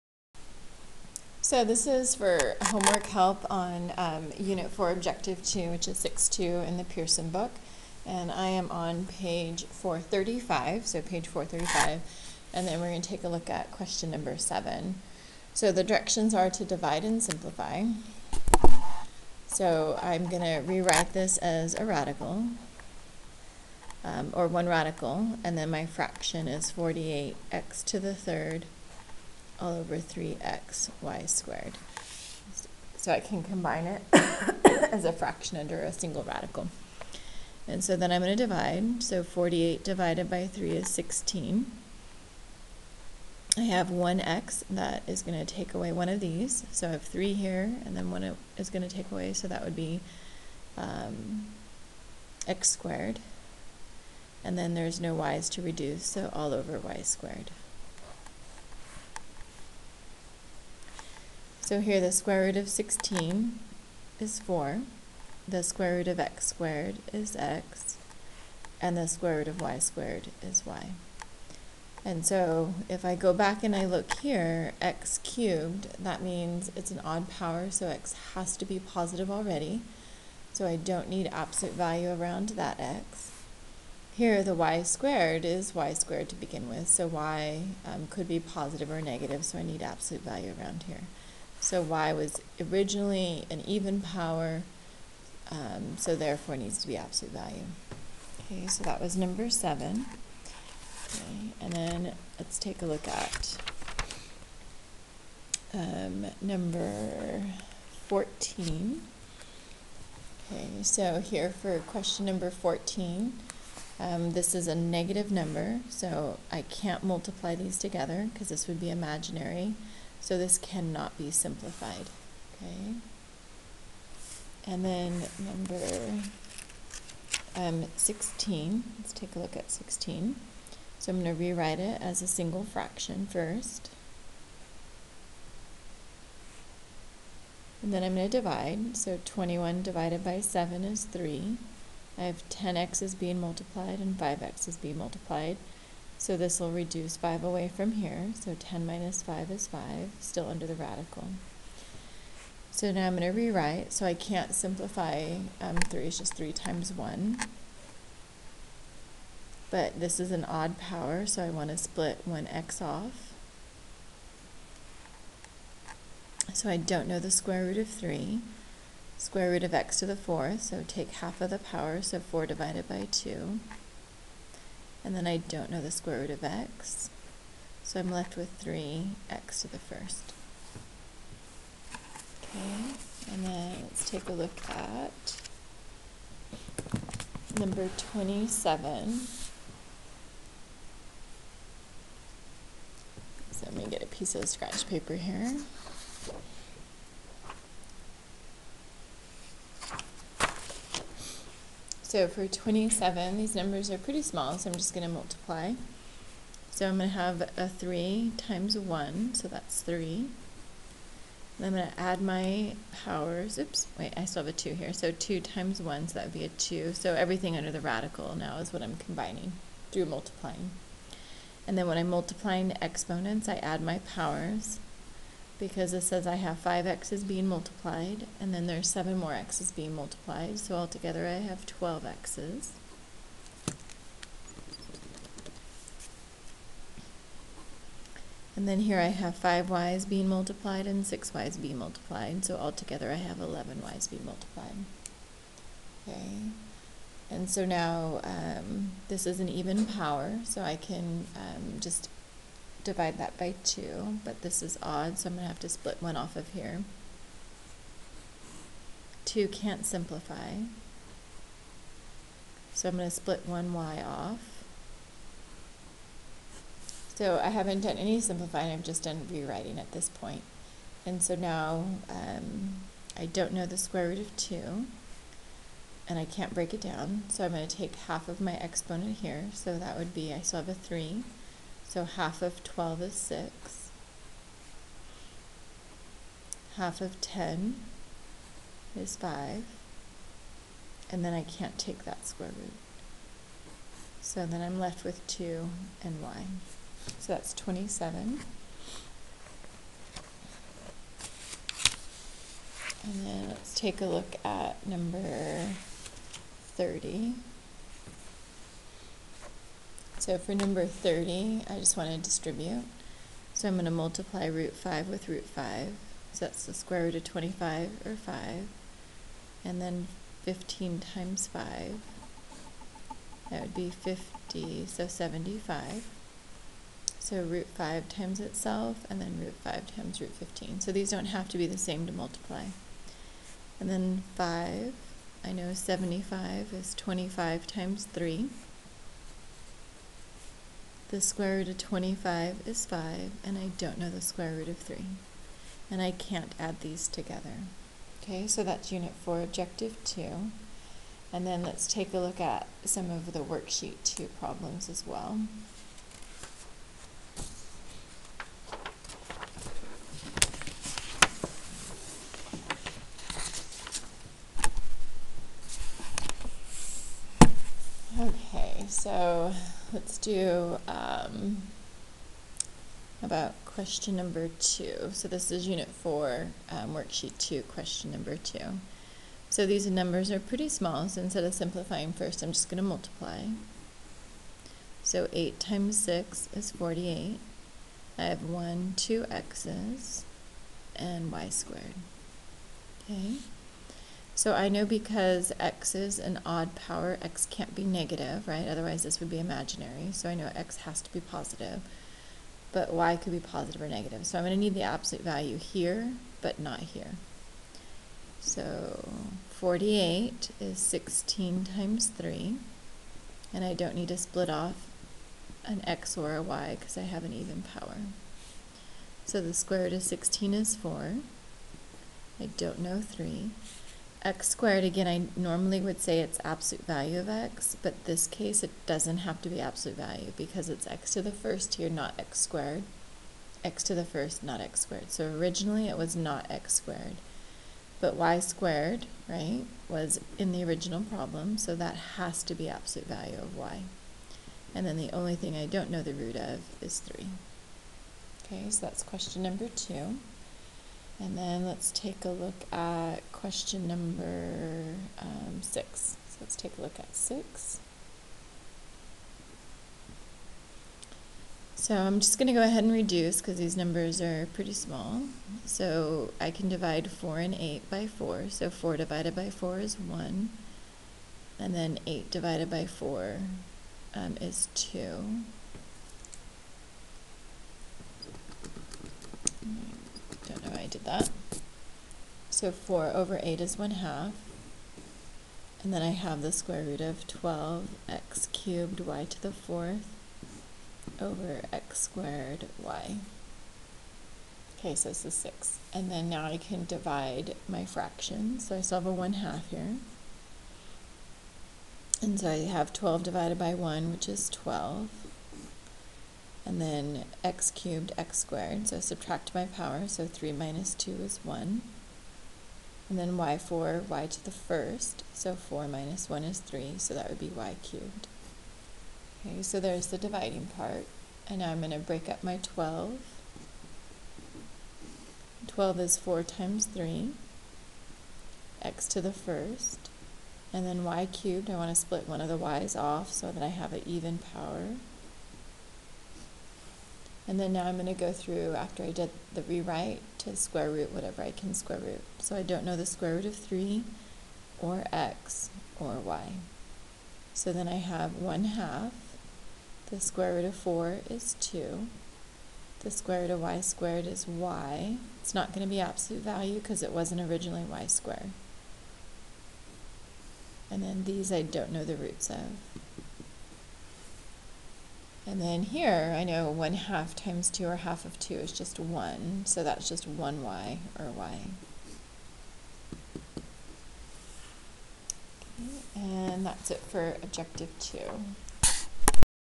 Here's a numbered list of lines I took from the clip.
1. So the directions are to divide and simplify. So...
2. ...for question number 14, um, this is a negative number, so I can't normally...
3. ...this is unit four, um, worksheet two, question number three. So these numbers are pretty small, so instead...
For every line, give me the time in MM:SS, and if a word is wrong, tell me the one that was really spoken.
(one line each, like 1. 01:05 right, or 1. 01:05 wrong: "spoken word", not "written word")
1. 00:15 right
2. 01:51 wrong: "multiply", not "normally"
3. 06:15 wrong: "two", not "three".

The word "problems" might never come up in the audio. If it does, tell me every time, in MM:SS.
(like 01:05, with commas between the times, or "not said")
05:54, 07:21.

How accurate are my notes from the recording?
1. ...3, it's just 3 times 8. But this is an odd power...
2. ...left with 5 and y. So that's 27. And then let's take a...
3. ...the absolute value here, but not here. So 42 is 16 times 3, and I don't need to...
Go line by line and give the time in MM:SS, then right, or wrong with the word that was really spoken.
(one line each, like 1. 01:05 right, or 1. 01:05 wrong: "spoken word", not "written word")
1. 02:35 wrong: "1", not "8"
2. 04:54 wrong: "2", not "5"
3. 06:44 wrong: "48", not "42".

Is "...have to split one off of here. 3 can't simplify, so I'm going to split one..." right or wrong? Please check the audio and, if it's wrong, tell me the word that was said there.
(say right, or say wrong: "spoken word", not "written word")
wrong: "2", not "3".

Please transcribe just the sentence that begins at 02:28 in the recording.
So 10 minus 5 is 5, still under the radical.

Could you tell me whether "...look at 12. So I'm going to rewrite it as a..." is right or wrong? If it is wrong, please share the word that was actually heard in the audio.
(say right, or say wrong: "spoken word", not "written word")
wrong: "16", not "12".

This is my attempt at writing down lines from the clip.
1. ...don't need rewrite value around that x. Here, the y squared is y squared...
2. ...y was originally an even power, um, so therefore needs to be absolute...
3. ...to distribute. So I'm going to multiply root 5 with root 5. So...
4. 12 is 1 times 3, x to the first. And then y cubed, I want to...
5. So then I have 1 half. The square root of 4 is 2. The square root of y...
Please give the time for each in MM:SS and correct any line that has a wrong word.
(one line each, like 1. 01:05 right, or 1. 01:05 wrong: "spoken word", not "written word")
1. 01:20 wrong: "absolute", not "rewrite"
2. 01:31 right
3. 05:12 right
4. 08:45 wrong: "4", not "1"
5. 09:07 right.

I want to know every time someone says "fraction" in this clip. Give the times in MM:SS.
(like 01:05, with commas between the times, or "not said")
00:25, 00:35, 02:12, 08:17.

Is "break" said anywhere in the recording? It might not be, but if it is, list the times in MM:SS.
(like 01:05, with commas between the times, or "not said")
04:36, 08:41.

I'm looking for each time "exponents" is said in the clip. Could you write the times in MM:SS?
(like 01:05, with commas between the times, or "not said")
03:42, 04:38.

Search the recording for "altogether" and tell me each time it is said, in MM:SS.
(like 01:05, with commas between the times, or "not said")
03:50, 04:02.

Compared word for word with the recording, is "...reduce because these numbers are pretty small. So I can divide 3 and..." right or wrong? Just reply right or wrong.
wrong.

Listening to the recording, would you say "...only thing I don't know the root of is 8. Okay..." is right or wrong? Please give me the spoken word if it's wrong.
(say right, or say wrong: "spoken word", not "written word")
wrong: "3", not "8".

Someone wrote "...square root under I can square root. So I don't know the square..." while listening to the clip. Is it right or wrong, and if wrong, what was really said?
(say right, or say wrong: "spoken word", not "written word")
wrong: "whatever", not "under".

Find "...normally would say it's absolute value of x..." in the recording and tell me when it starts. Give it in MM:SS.
07:05.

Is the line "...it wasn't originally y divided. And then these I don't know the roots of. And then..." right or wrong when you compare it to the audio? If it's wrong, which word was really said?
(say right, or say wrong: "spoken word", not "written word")
wrong: "squared", not "divided".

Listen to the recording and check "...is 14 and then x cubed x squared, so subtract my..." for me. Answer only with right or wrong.
wrong.